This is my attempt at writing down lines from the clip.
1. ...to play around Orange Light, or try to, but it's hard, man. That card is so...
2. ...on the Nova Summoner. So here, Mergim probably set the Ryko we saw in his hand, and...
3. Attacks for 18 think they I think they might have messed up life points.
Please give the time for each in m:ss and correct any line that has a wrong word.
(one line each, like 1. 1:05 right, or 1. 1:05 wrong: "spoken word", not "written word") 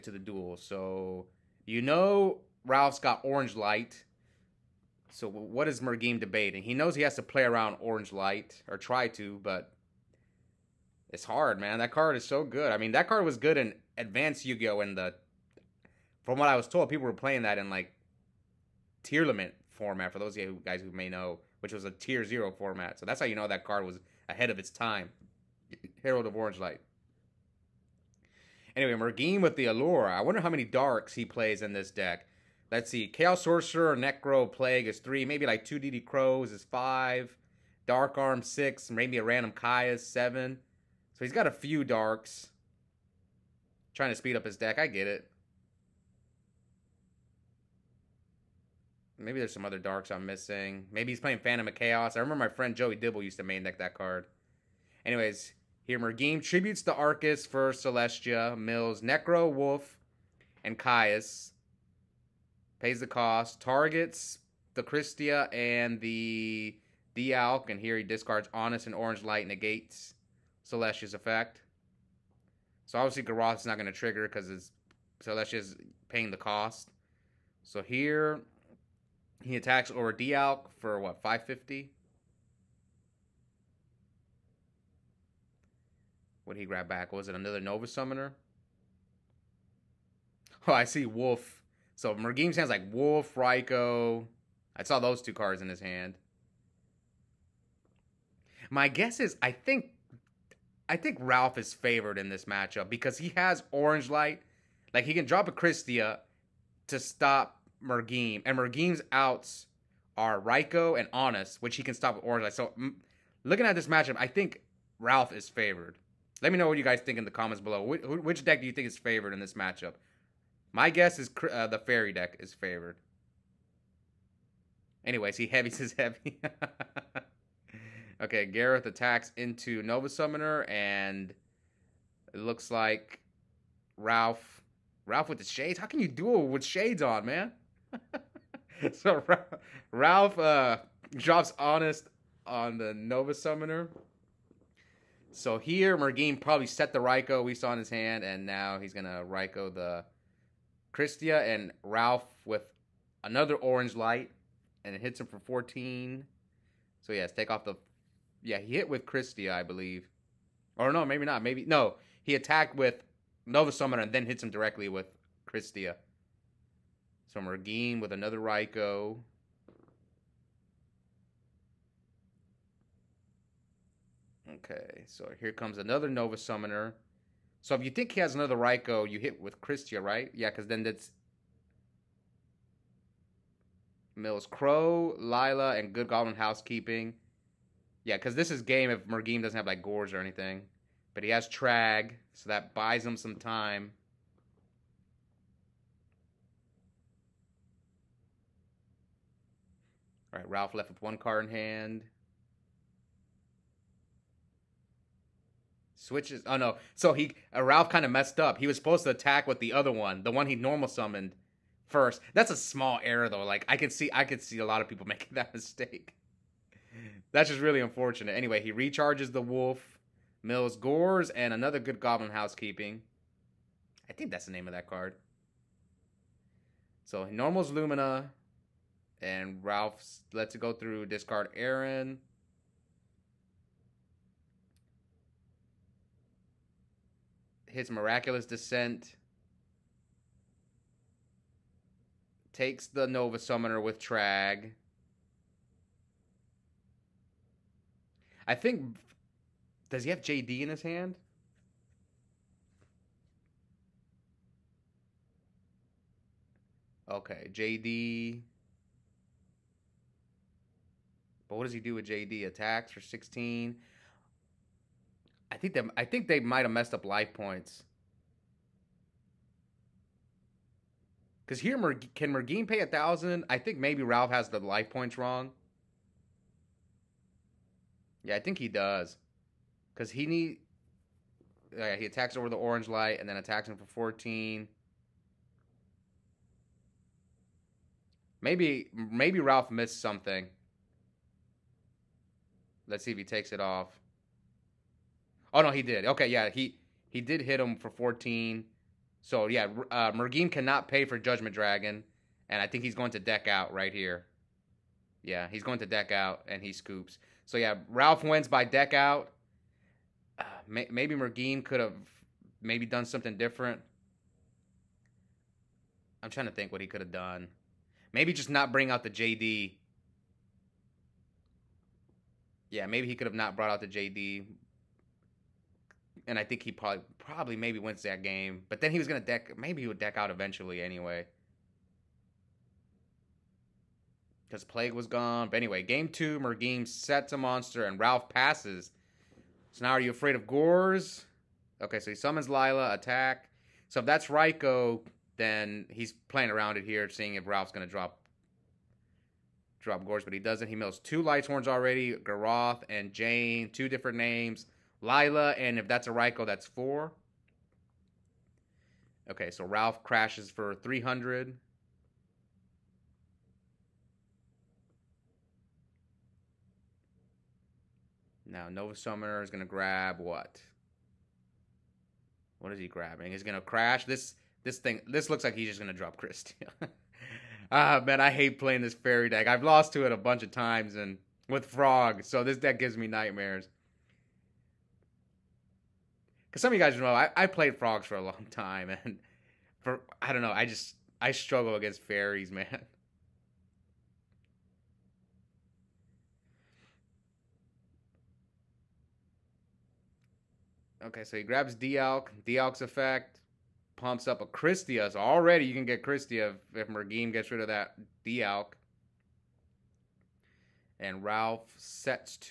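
1. 0:07 right
2. 2:22 right
3. 4:22 wrong: "16", not "18".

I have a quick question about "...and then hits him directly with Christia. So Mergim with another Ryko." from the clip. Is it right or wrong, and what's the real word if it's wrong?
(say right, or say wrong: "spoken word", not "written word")
right.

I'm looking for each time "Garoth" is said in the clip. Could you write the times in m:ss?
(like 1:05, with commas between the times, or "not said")
1:13, 2:08, 5:52.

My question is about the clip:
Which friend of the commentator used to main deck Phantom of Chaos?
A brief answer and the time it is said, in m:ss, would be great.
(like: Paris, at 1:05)
Joey Dibble, at 0:52.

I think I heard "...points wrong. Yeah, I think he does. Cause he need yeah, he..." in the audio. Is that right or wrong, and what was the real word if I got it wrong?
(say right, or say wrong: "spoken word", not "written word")
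right.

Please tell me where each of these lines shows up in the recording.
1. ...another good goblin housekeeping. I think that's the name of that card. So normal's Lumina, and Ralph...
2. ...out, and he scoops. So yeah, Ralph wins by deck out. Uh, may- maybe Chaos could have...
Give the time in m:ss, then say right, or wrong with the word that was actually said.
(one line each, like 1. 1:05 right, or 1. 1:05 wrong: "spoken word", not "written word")
1. 3:41 right
2. 5:06 wrong: "Mergim", not "Chaos".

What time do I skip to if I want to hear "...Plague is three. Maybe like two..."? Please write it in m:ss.
0:34.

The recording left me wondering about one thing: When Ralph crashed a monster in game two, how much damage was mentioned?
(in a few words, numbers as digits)
300.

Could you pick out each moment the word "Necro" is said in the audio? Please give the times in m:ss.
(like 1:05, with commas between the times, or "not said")
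0:33, 0:59.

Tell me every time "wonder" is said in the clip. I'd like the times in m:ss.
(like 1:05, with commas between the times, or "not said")
0:30.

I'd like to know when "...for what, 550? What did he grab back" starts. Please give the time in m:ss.
1:20.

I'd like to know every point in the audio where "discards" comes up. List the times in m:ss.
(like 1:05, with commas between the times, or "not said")
1:08, 3:51.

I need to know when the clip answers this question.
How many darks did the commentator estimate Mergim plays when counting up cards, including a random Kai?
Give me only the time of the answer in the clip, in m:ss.
0:40.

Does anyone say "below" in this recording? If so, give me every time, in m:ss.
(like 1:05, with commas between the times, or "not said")
1:57.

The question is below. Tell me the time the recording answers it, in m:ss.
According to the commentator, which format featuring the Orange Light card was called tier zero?
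0:19.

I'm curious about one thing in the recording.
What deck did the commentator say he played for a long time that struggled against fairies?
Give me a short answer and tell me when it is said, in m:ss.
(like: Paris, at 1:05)
frogs, at 6:27.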